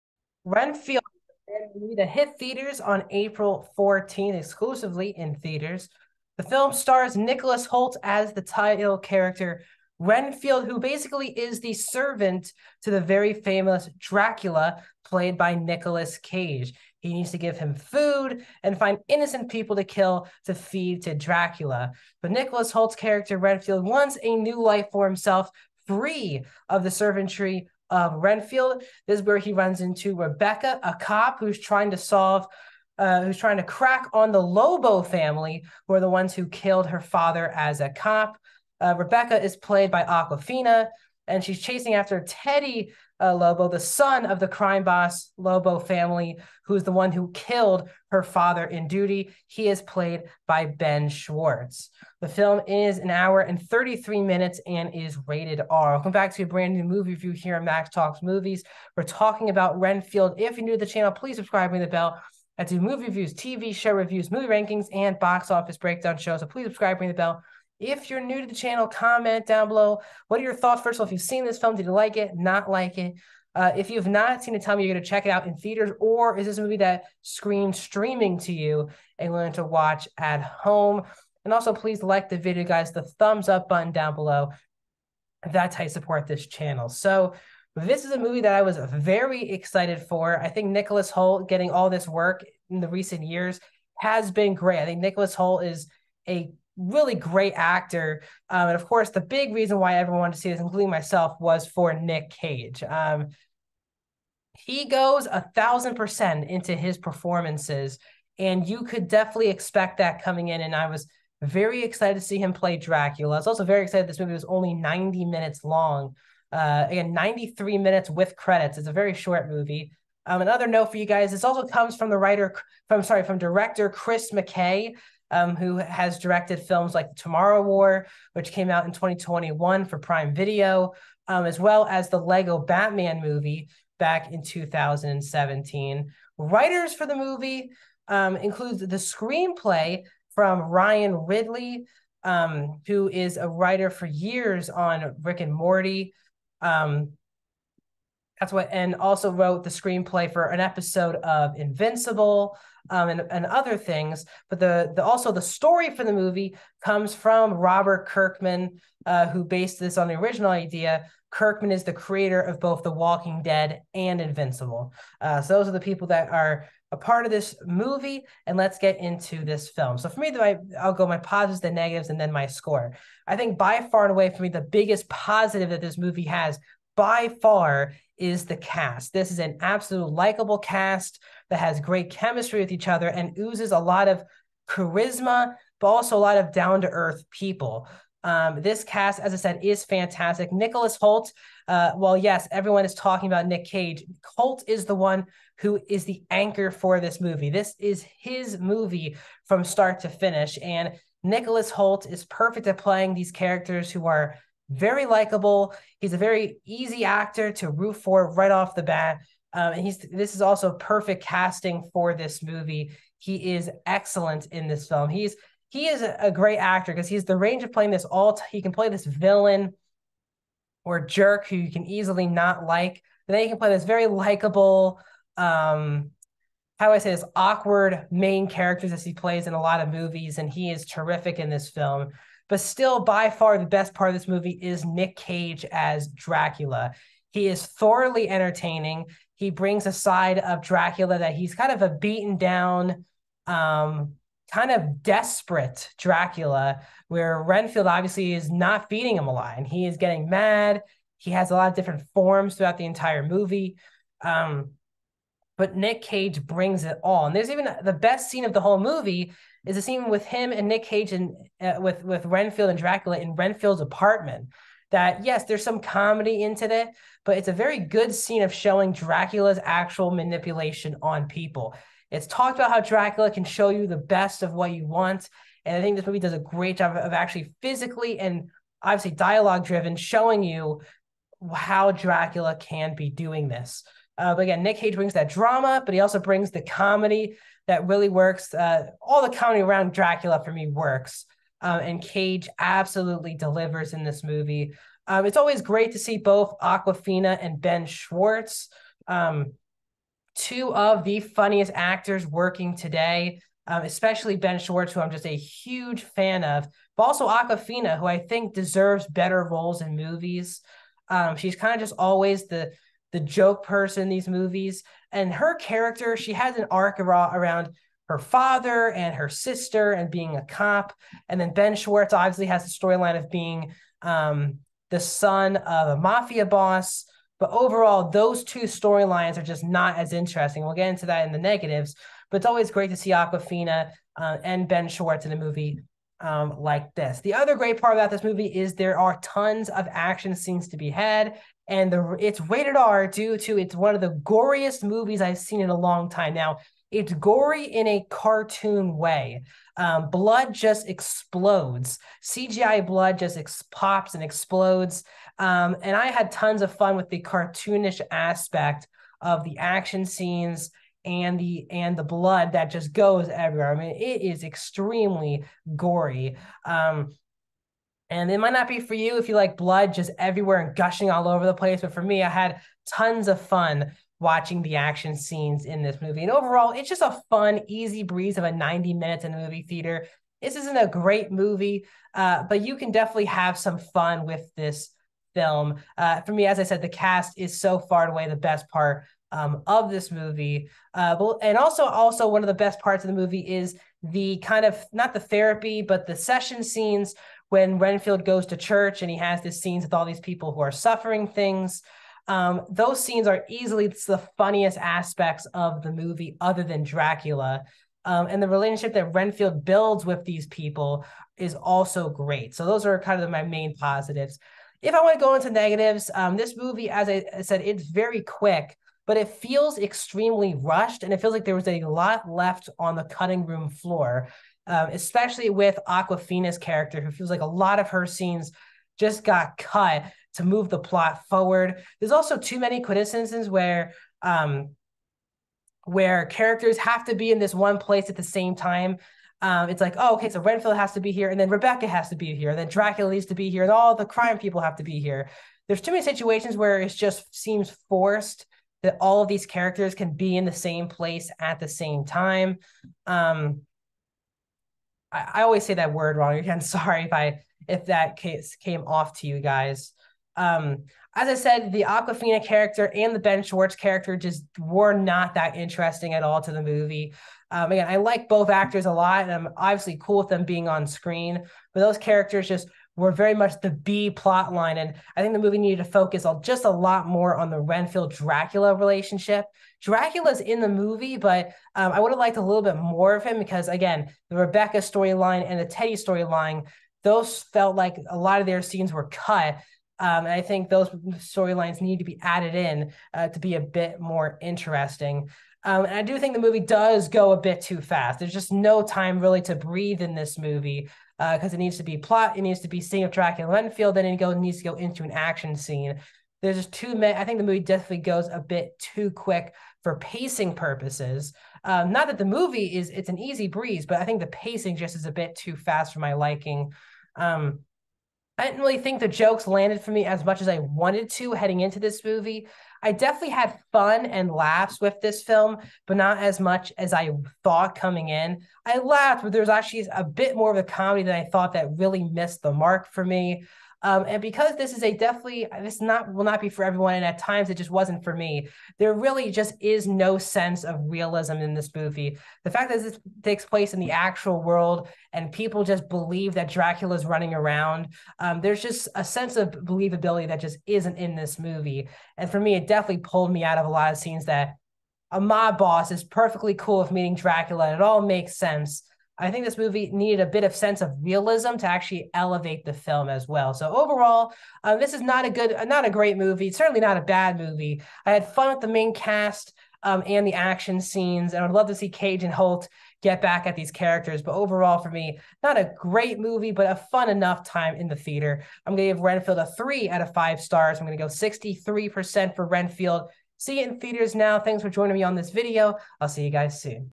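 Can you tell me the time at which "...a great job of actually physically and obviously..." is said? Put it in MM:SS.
04:36.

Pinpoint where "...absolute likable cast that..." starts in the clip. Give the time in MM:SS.
02:59.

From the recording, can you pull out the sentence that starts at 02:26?
Um, that's what, and also wrote the screenplay for an episode of Invincible um, and, and other things.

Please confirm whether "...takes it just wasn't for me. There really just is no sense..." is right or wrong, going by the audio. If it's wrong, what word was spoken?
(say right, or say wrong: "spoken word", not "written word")
wrong: "times", not "takes".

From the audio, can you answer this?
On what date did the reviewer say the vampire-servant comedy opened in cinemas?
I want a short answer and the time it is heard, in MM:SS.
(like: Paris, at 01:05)
April 14th, at 00:03.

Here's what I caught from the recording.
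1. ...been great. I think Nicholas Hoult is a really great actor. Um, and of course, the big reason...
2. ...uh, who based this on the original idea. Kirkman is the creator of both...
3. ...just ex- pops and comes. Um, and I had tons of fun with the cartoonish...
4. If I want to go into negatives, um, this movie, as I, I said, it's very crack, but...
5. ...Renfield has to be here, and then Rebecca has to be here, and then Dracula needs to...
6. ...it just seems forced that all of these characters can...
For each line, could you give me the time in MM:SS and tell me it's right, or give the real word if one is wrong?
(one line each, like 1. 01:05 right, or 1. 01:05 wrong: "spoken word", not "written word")
1. 01:34 right
2. 02:39 right
3. 05:53 wrong: "explodes", not "comes"
4. 06:54 wrong: "quick", not "crack"
5. 07:20 right
6. 07:26 right.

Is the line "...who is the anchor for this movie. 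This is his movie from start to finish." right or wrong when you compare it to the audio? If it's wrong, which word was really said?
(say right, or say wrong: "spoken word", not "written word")
right.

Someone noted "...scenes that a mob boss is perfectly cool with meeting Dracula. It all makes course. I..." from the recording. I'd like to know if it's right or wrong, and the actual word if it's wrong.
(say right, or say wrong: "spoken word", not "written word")
wrong: "sense", not "course".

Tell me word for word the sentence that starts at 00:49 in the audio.
He is played by Ben Schwartz.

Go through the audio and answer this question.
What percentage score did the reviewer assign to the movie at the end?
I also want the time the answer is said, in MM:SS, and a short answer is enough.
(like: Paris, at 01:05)
63%, at 09:41.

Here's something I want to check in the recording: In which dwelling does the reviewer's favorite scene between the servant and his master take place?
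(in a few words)
Renfield's apartment.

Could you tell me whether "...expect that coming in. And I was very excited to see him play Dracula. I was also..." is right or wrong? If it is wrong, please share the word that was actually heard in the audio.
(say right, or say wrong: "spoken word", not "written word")
right.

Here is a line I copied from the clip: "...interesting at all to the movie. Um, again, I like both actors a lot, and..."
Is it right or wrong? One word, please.
right.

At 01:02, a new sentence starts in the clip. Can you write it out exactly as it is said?
I do movie reviews, TV show reviews, movie rankings, and box office breakdown shows.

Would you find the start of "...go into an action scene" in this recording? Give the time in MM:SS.
08:24.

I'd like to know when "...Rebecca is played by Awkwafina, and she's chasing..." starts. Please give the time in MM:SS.
00:38.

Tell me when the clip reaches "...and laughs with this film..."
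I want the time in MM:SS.
08:44.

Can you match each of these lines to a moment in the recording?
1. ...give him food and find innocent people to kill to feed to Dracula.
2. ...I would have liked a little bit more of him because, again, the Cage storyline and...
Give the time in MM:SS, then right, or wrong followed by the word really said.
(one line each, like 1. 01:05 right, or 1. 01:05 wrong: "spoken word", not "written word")
1. 00:17 right
2. 08:01 wrong: "Rebecca", not "Cage".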